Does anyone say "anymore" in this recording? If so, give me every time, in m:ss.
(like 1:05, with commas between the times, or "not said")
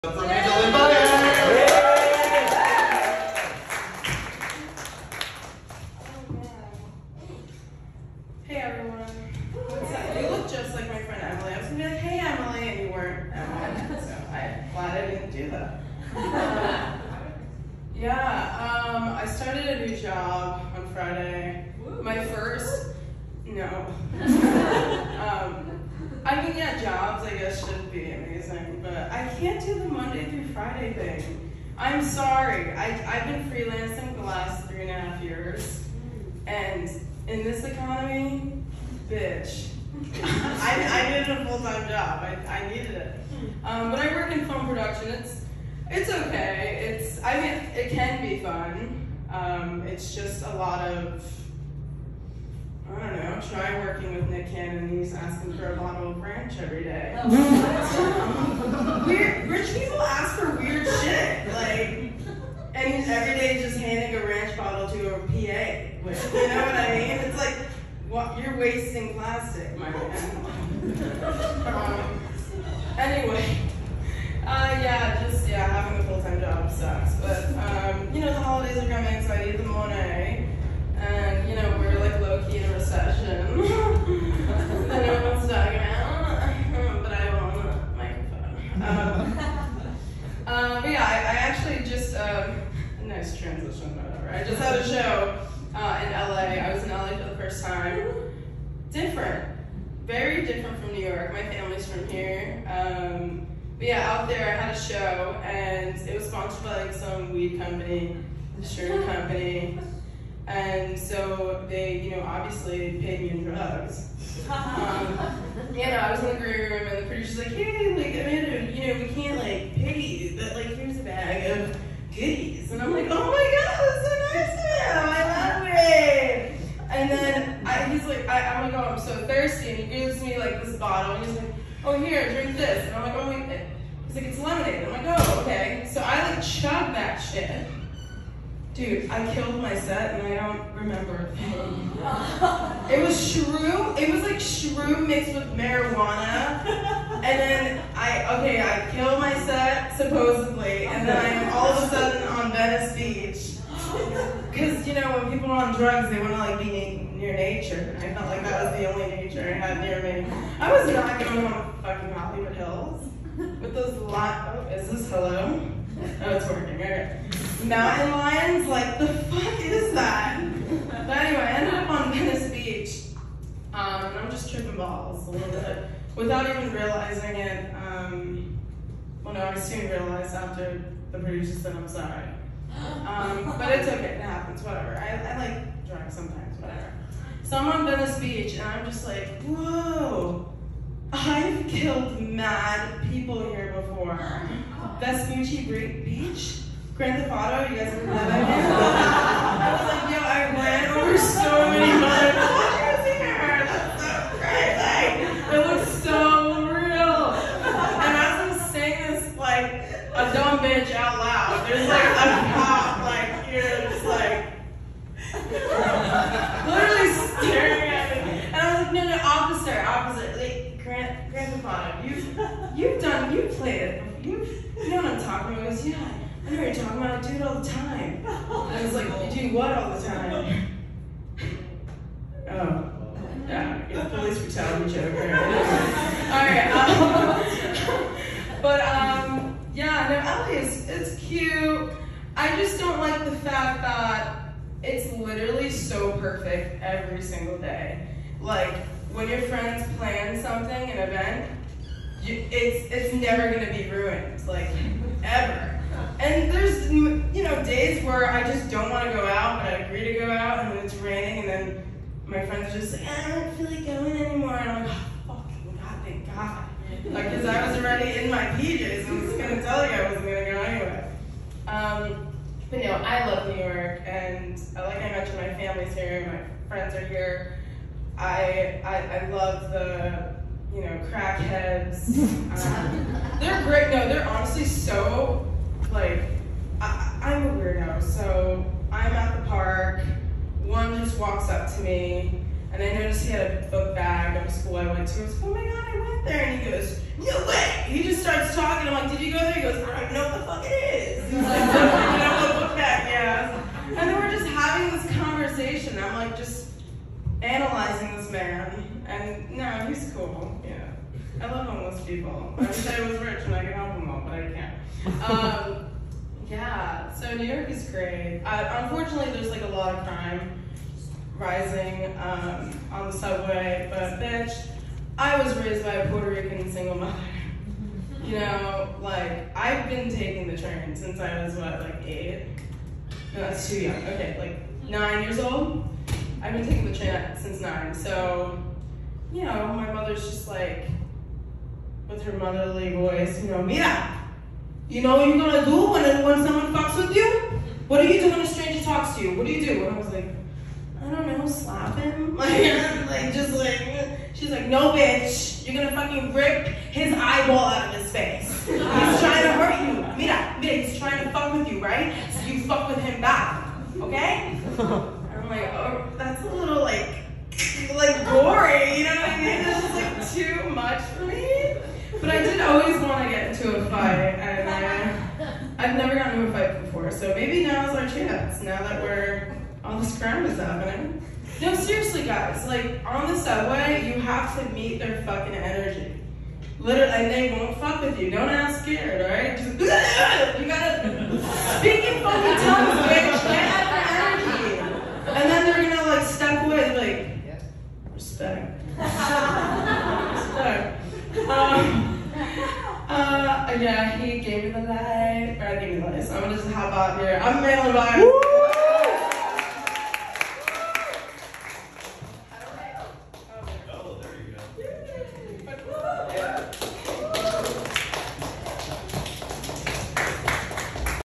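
4:24.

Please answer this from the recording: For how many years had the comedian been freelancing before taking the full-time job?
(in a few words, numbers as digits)
3 and a half.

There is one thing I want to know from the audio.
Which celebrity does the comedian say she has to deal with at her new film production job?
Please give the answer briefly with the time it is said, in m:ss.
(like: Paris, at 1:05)
Nick Cannon, at 0:54.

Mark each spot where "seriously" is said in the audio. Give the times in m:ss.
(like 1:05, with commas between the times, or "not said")
6:21.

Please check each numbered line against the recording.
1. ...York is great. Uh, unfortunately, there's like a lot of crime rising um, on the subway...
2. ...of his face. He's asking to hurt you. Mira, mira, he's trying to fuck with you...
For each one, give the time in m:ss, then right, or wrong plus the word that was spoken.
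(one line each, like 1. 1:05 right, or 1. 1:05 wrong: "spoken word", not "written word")
1. 5:17 right
2. 5:57 wrong: "trying", not "asking".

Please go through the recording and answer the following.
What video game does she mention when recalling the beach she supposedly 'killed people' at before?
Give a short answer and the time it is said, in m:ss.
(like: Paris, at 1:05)
Grand Theft Auto, at 3:16.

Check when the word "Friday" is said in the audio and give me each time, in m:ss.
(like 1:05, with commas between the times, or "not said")
0:20, 0:30.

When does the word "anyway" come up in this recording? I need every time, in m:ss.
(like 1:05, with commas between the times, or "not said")
1:12, 2:51.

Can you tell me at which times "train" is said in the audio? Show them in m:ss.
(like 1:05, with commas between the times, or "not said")
5:30, 5:36.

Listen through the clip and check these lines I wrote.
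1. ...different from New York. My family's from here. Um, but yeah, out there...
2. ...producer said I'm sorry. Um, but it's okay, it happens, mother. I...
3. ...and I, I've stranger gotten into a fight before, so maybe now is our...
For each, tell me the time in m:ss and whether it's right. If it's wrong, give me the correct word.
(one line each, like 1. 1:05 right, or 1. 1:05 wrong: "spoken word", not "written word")
1. 1:40 right
2. 3:01 wrong: "whatever", not "mother"
3. 6:14 wrong: "never", not "stranger".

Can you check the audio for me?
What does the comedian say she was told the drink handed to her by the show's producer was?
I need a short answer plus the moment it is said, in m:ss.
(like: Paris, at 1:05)
lemonade, at 2:14.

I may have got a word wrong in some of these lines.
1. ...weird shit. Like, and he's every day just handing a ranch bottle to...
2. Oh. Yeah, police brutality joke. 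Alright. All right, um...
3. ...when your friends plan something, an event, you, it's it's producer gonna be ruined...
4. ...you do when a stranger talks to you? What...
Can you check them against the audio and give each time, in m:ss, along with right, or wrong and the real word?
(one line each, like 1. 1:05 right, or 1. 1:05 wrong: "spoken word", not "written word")
1. 1:00 right
2. 3:52 right
3. 4:09 wrong: "never", not "producer"
4. 5:48 right.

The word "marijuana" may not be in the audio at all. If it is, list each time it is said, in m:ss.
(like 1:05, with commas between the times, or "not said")
2:25.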